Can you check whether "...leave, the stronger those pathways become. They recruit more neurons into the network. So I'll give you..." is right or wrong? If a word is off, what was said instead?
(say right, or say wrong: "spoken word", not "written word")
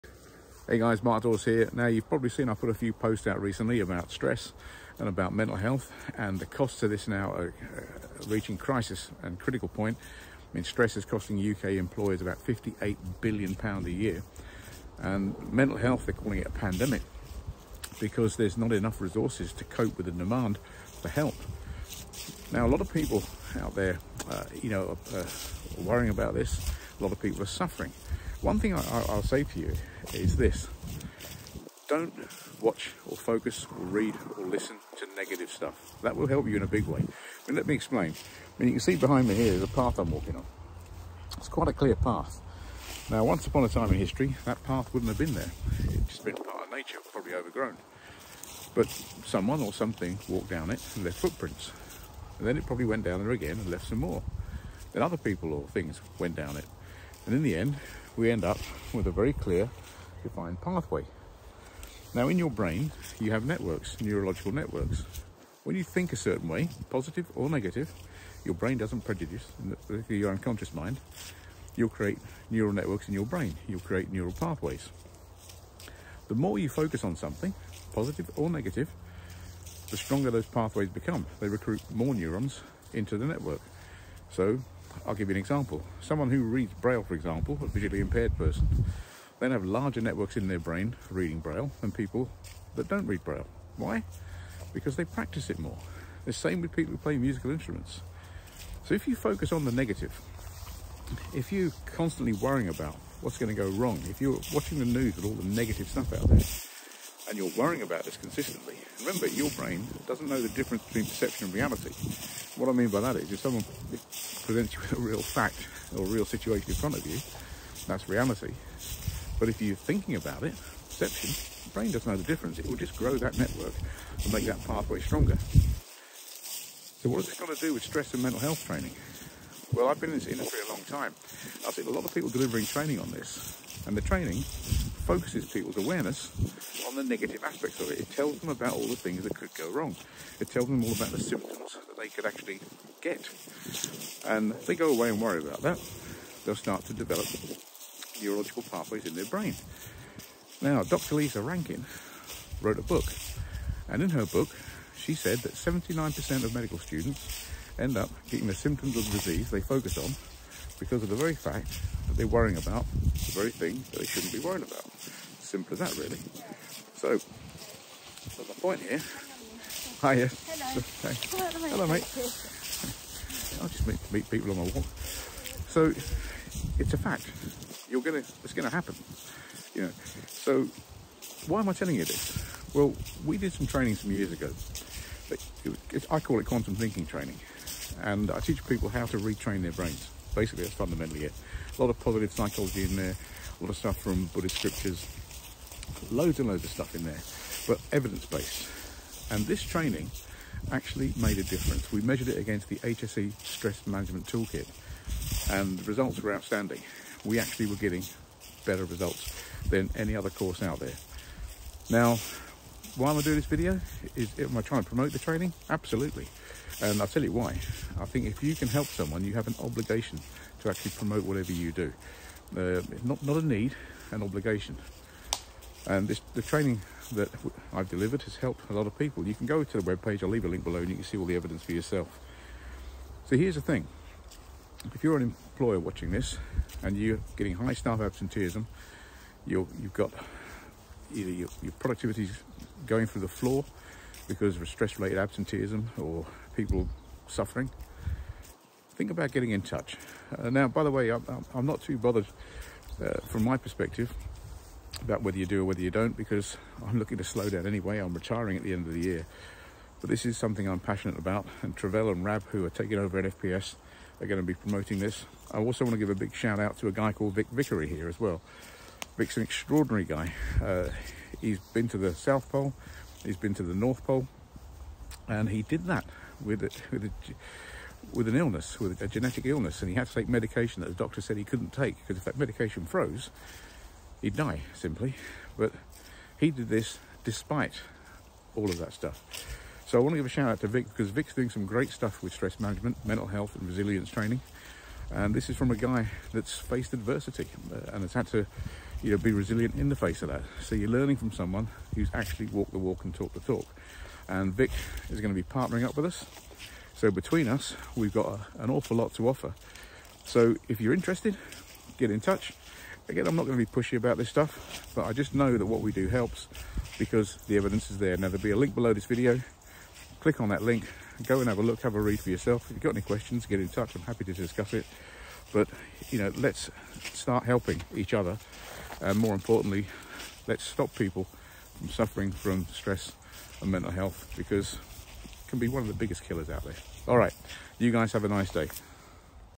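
wrong: "negative", not "leave".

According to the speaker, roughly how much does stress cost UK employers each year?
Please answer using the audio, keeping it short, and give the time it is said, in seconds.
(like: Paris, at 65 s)
£58 billion, at 12 s.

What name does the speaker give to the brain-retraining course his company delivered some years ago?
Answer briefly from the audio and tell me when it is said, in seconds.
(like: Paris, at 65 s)
quantum thinking training, at 186 s.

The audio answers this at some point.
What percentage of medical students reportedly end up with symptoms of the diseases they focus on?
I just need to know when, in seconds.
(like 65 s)
155 s.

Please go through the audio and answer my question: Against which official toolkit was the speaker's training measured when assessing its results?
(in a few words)
HSE Stress Management Toolkit.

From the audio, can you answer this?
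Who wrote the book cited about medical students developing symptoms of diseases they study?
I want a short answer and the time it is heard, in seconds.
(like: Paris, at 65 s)
Dr. Lisa Rankin, at 150 s.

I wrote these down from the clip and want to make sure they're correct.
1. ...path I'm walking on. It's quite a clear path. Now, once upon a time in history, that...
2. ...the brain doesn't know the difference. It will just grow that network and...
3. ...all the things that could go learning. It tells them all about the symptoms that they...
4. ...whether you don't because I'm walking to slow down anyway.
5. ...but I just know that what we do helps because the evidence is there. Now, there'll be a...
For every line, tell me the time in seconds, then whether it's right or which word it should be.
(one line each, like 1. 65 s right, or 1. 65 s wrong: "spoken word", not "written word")
1. 39 s right
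2. 121 s right
3. 138 s wrong: "wrong", not "learning"
4. 255 s wrong: "looking", not "walking"
5. 314 s right.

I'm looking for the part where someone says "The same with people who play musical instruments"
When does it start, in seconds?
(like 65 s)
96 s.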